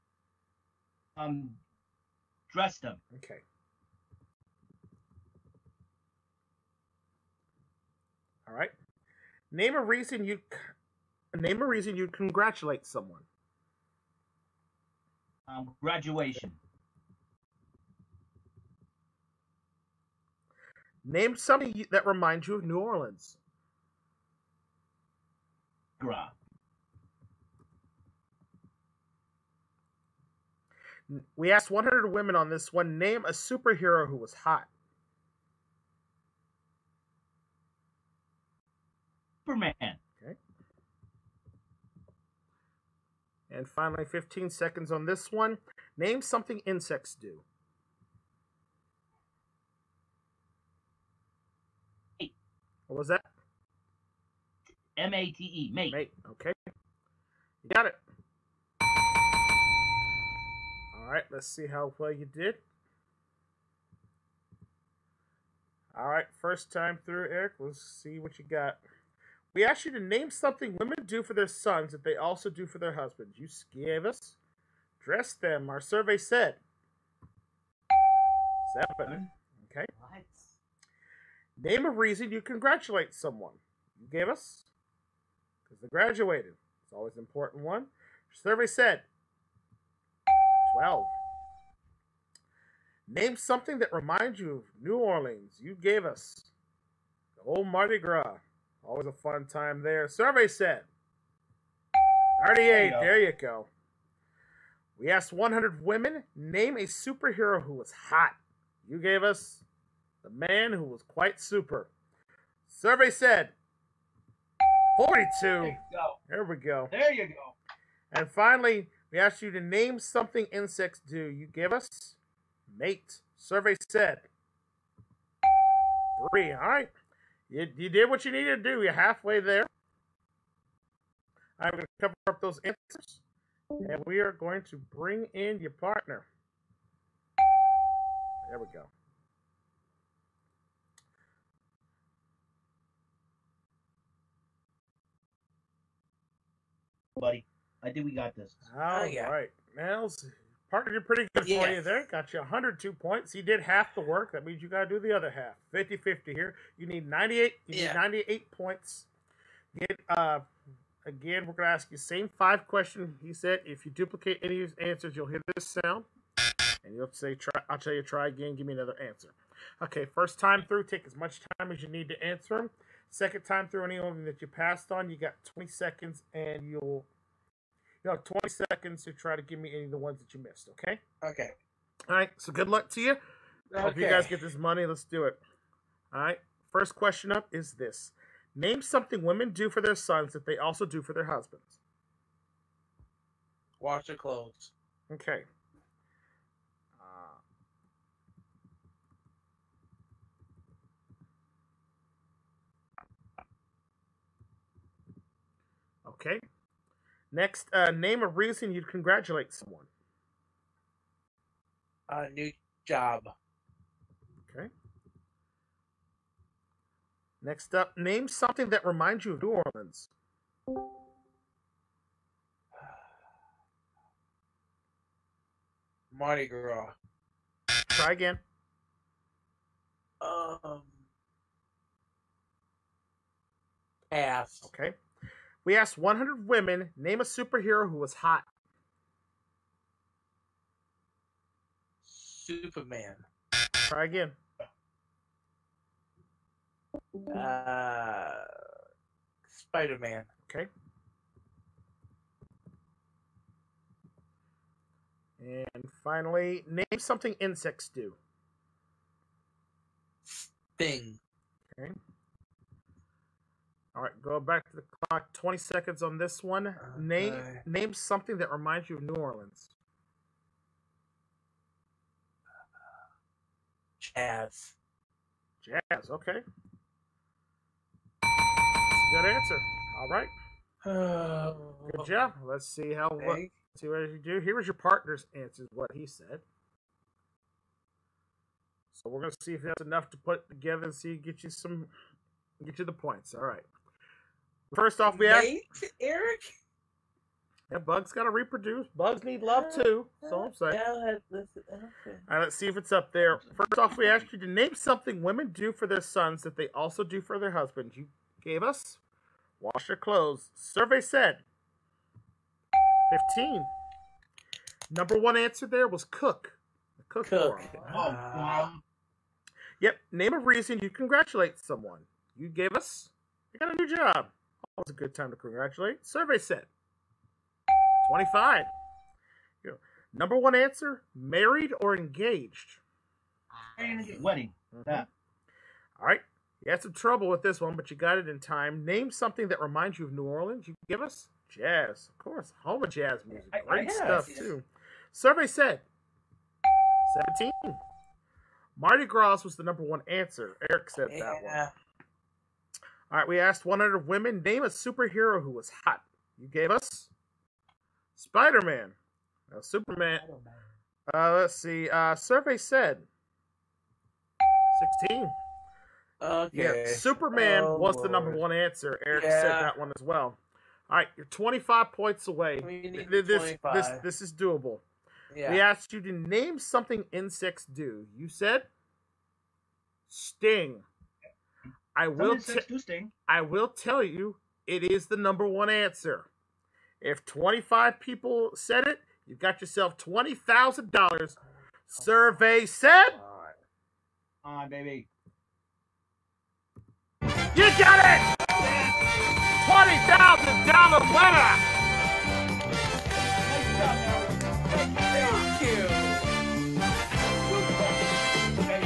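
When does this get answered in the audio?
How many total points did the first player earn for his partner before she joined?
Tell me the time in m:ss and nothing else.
2:32.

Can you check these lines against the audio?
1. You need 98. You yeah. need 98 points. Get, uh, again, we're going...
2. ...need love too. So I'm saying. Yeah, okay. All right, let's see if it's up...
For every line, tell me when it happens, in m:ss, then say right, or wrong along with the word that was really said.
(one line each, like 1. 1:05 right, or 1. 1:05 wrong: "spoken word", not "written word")
1. 2:36 right
2. 4:59 right.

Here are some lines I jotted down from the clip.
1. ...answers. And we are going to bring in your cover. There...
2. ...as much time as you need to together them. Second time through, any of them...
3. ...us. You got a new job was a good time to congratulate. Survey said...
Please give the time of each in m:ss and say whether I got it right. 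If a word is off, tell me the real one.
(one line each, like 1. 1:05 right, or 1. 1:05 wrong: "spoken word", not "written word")
1. 2:12 wrong: "partner", not "cover"
2. 2:51 wrong: "answer", not "together"
3. 5:22 right.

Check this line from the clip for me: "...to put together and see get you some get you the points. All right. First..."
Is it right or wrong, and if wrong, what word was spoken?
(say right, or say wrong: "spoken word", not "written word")
right.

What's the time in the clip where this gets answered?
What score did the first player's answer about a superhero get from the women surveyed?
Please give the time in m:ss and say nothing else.
1:54.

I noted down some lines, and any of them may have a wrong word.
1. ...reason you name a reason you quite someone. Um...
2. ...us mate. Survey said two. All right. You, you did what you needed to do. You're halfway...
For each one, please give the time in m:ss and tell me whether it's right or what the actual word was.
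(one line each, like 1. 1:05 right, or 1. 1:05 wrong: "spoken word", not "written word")
1. 0:09 wrong: "congratulate", not "quite"
2. 2:01 wrong: "three", not "two".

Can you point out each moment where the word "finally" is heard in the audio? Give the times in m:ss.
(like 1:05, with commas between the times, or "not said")
0:43, 1:58, 4:16.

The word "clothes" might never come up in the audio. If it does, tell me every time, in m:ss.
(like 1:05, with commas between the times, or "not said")
3:14, 5:09.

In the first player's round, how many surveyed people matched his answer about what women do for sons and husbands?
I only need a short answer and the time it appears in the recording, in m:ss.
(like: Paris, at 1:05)
7, at 1:18.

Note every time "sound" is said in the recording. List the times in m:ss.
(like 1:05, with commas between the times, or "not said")
2:45.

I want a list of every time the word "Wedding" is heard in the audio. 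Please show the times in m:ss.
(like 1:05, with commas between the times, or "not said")
5:34.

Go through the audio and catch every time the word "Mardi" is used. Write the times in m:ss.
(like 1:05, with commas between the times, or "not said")
1:37, 3:46, 5:48.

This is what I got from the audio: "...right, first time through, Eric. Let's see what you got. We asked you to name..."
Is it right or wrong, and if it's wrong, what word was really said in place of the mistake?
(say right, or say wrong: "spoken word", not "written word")
right.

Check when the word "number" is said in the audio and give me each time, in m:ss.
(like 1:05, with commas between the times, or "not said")
5:14, 5:30, 5:49, 6:08, 6:25.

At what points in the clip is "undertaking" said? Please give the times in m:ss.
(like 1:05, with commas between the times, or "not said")
not said.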